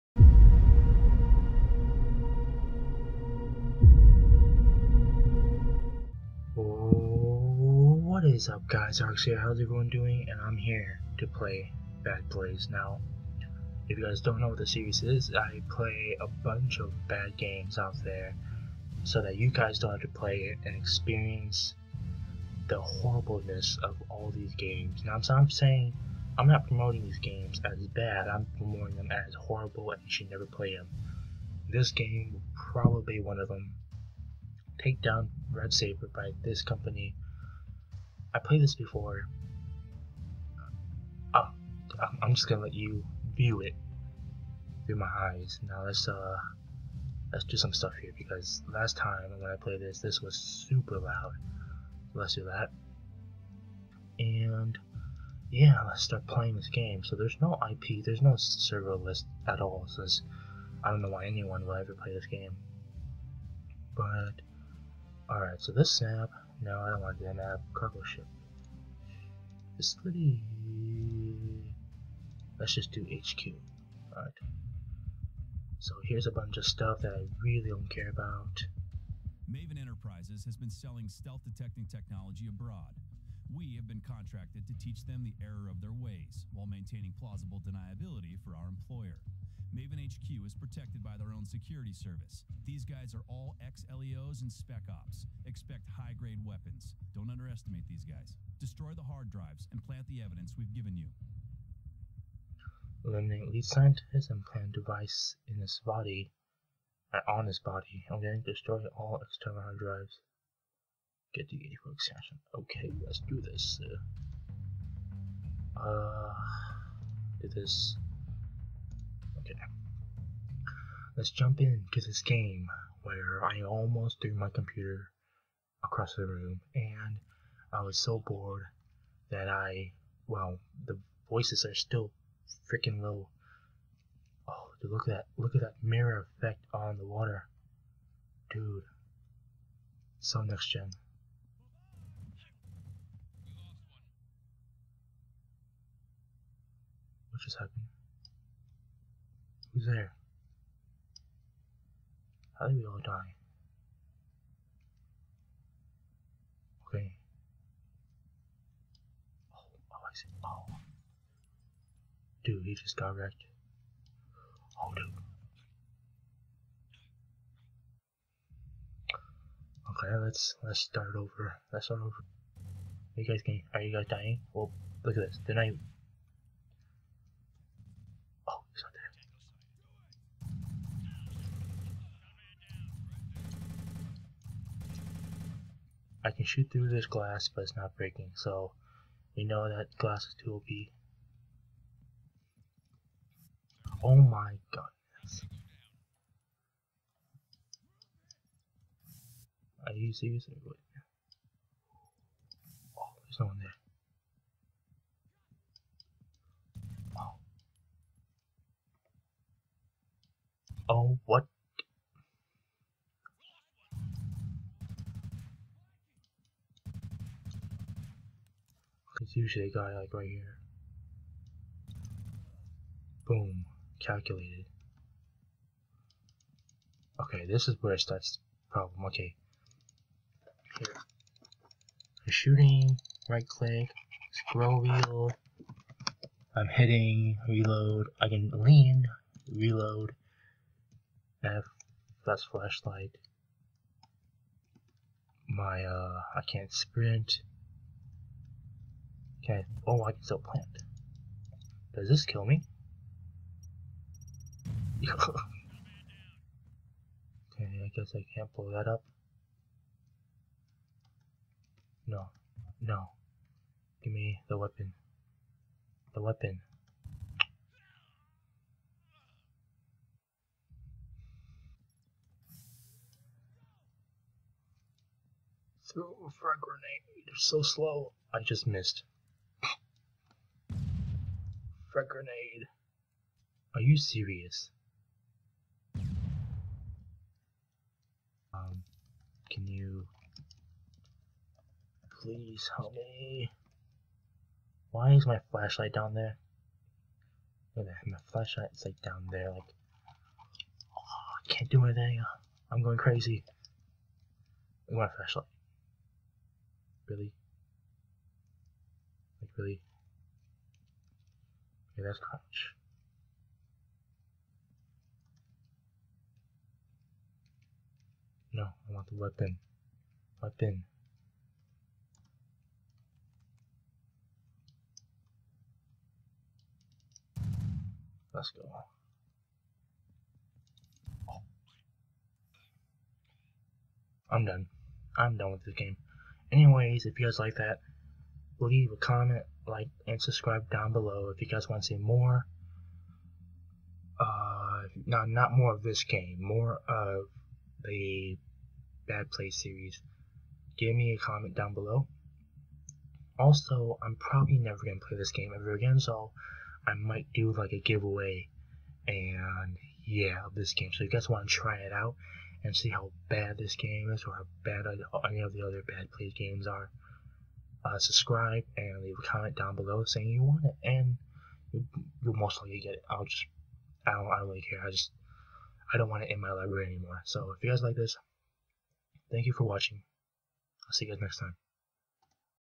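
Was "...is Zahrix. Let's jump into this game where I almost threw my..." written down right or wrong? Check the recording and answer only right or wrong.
wrong.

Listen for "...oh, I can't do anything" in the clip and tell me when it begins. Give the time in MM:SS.
05:00.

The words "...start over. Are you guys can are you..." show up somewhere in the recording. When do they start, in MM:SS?
02:51.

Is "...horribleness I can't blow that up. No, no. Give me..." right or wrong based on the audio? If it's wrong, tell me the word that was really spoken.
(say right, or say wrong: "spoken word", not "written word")
wrong: "guess", not "horribleness".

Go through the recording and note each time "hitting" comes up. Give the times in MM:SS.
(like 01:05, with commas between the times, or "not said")
03:56.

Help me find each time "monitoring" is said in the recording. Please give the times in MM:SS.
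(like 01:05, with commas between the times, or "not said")
not said.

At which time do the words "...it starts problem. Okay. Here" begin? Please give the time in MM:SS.
03:47.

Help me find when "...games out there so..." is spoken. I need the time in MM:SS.
00:17.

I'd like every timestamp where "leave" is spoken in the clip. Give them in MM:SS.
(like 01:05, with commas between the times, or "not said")
05:38, 06:09.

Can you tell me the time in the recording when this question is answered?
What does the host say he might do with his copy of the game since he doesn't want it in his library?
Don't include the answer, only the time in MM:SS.
05:57.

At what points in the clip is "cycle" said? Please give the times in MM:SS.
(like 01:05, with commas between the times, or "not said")
not said.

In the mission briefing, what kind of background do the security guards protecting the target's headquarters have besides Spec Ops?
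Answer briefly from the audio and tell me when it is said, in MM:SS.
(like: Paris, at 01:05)
ex-LEOs, at 01:33.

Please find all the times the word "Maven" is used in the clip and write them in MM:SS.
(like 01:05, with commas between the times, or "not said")
01:19, 01:29.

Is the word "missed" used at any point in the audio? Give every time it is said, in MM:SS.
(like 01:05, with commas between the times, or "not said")
04:38.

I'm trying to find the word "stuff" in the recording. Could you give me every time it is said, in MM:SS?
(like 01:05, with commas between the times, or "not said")
00:47, 01:16.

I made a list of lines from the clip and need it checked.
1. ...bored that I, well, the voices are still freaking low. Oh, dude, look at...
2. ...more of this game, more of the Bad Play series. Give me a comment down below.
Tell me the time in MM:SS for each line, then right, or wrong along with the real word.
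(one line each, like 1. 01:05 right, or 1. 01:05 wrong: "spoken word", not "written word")
1. 02:08 right
2. 05:45 right.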